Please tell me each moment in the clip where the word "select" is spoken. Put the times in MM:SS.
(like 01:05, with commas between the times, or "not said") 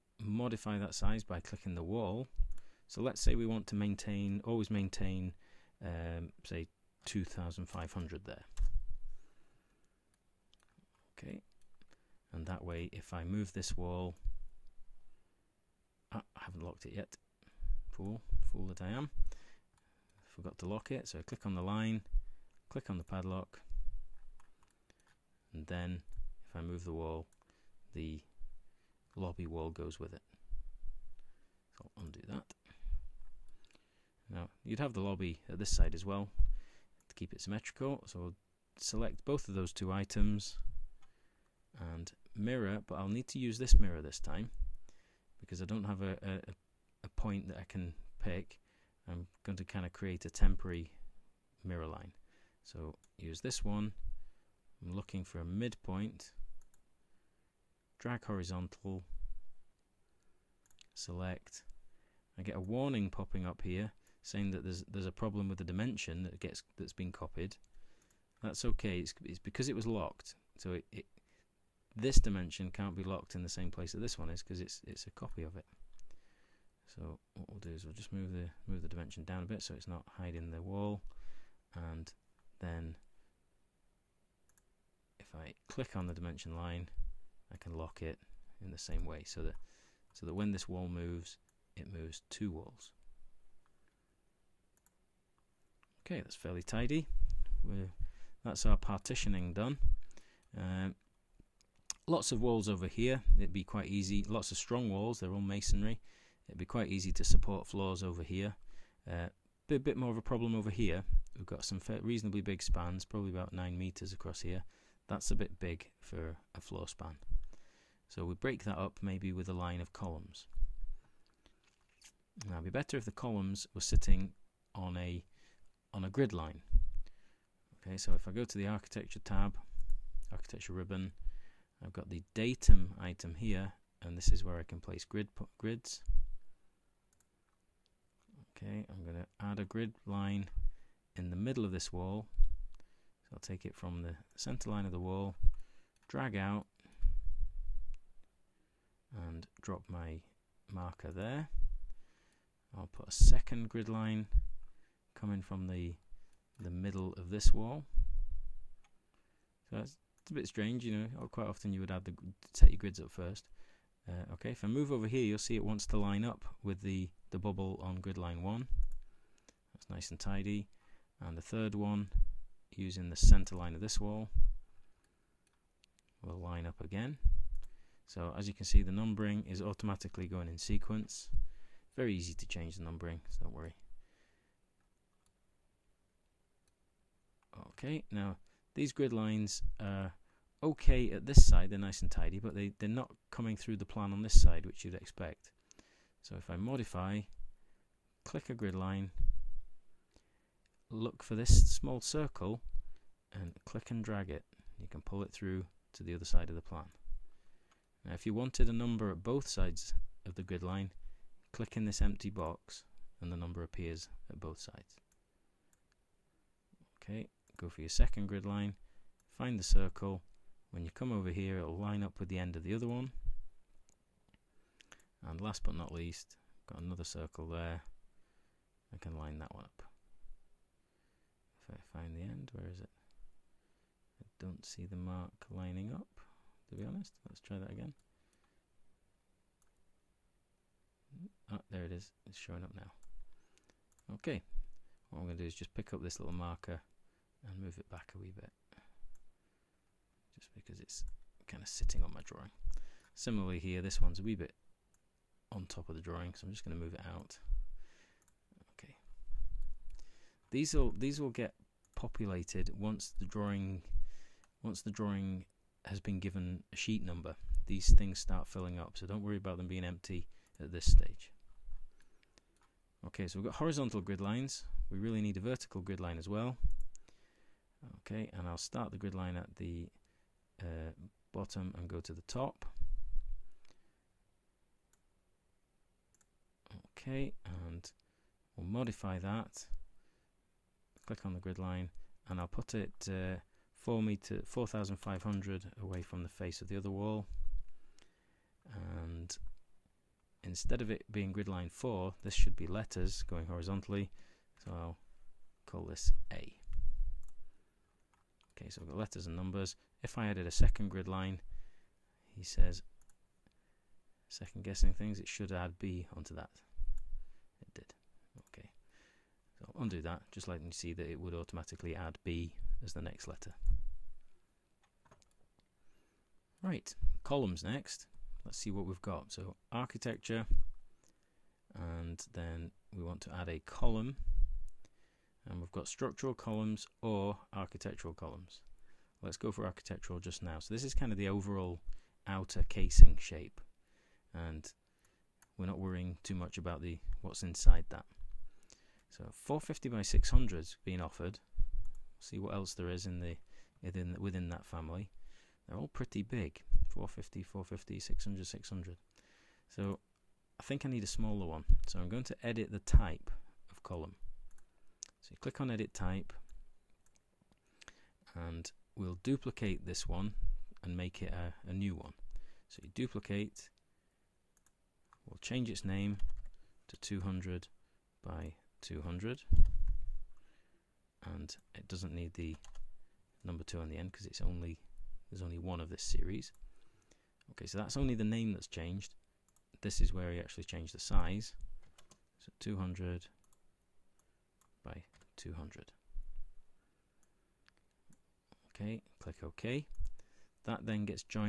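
00:38, 01:00.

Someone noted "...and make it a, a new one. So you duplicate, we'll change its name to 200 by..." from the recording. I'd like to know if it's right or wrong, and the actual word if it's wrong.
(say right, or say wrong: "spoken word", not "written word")
right.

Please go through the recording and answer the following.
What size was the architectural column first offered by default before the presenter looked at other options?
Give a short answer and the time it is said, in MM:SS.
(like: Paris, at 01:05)
450 by 600, at 05:49.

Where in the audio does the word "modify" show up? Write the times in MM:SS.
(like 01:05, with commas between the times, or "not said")
00:00, 03:16, 04:48.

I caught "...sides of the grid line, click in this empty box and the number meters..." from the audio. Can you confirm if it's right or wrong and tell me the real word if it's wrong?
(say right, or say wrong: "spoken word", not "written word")
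wrong: "appears", not "meters".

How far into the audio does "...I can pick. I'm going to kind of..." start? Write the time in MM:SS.
00:47.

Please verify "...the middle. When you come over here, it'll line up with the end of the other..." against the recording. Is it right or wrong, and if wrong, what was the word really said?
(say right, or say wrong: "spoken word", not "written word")
wrong: "circle", not "middle".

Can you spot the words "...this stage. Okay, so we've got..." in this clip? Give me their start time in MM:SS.
04:30.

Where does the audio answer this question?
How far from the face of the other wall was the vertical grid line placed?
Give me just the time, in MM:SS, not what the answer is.
04:54.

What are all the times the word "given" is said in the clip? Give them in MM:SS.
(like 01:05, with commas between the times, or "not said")
04:26.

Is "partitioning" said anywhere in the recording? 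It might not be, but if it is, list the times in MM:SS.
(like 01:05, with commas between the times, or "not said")
01:38.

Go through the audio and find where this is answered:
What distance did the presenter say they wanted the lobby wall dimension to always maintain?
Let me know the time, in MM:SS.
00:07.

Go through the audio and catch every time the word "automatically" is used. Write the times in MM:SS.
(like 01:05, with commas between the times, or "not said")
02:59, 05:21.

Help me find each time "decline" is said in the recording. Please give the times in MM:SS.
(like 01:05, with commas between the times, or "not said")
not said.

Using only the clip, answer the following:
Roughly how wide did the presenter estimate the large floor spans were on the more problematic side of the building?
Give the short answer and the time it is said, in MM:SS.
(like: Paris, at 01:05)
9 meters, at 01:53.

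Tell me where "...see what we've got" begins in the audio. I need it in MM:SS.
05:28.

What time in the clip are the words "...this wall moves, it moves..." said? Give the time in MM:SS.
01:30.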